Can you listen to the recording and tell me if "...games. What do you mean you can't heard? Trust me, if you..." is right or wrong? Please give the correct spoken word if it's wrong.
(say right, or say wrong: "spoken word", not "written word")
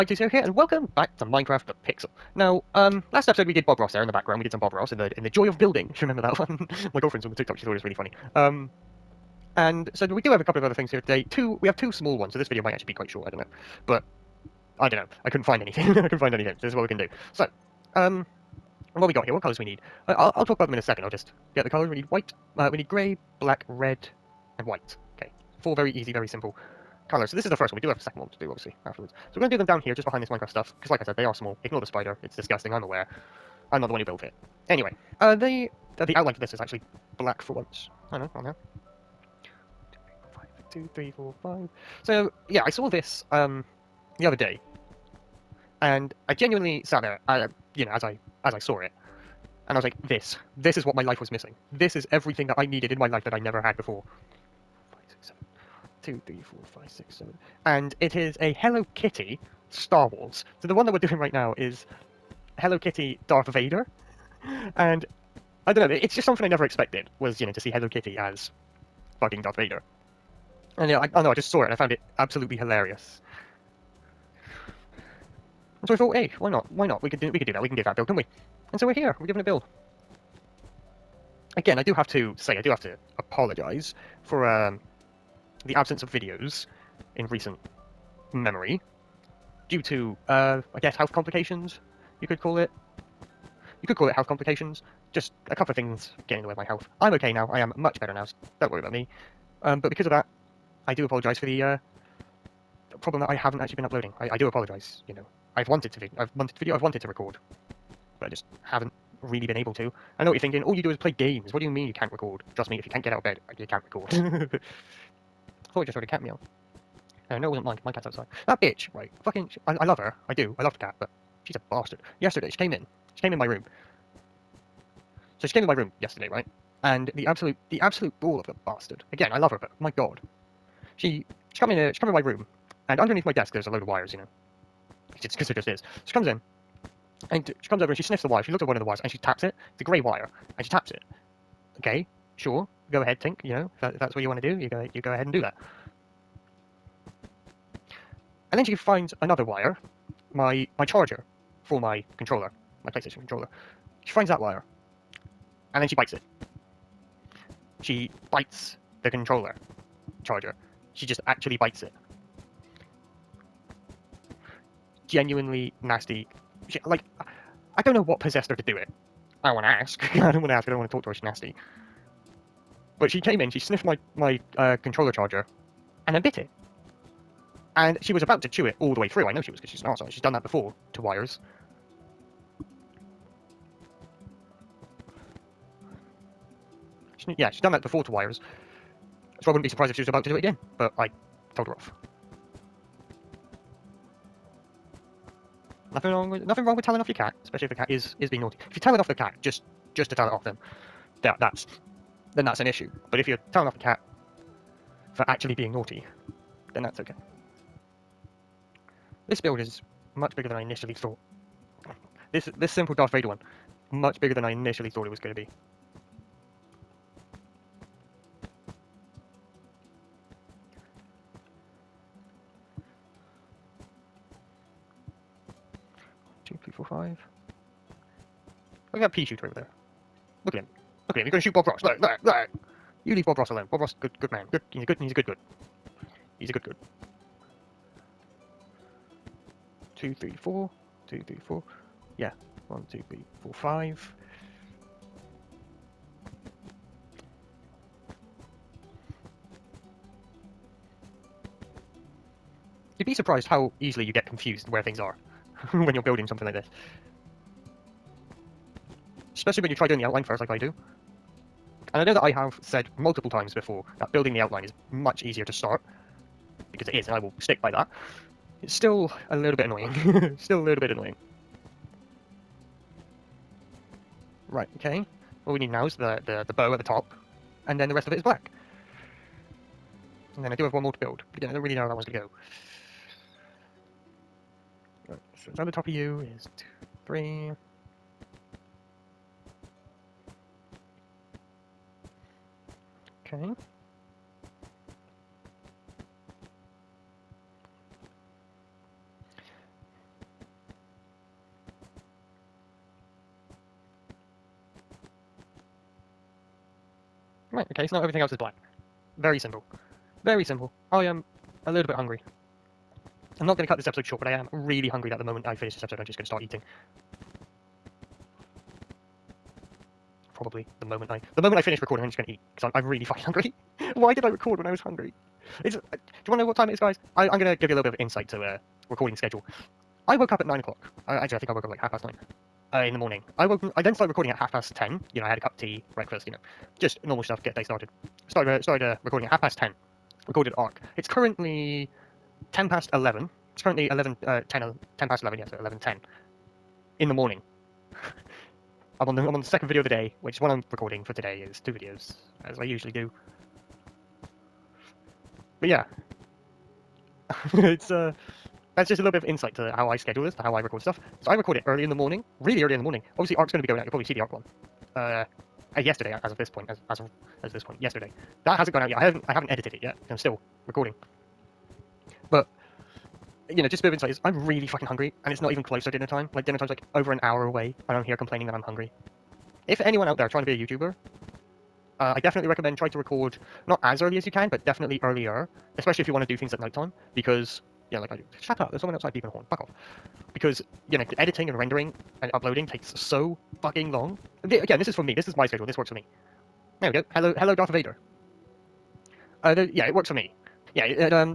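wrong: "record", not "heard".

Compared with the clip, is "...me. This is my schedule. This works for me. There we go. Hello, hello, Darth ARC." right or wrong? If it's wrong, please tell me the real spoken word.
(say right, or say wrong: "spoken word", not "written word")
wrong: "Vader", not "ARC".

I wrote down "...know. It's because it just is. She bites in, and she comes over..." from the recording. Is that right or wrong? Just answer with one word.
wrong.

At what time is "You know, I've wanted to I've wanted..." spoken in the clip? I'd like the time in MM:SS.
01:45.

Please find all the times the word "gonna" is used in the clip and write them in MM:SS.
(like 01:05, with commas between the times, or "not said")
05:27.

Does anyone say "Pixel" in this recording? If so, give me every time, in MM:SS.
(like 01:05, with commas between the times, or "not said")
00:01.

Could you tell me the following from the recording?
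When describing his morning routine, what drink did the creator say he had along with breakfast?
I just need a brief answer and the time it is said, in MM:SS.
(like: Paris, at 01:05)
Tea, at 05:35.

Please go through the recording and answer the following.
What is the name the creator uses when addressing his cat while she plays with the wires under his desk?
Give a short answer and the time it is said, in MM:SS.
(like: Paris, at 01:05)
Tink, at 02:23.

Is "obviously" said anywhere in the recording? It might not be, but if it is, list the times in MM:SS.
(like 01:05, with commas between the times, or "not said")
00:28, 06:03.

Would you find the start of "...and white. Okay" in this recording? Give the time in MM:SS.
00:24.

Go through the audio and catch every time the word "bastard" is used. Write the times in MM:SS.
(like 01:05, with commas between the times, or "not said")
02:01, 02:08.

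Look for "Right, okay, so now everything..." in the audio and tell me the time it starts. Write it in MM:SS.
05:07.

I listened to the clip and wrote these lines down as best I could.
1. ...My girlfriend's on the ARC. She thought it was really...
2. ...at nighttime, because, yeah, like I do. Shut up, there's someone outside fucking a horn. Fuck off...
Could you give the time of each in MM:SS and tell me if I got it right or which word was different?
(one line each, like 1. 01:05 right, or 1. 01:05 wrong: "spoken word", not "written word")
1. 00:06 wrong: "TikTok", not "ARC"
2. 06:26 wrong: "beeping", not "fucking".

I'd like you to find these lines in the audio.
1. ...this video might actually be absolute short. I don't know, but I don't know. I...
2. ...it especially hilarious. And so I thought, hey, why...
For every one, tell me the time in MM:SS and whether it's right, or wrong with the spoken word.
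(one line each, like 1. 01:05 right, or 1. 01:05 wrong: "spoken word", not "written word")
1. 00:12 wrong: "quite", not "absolute"
2. 01:11 wrong: "absolutely", not "especially".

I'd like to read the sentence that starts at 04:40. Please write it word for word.
And then I do have one more to build, but again, I don't really know how that one's going to go.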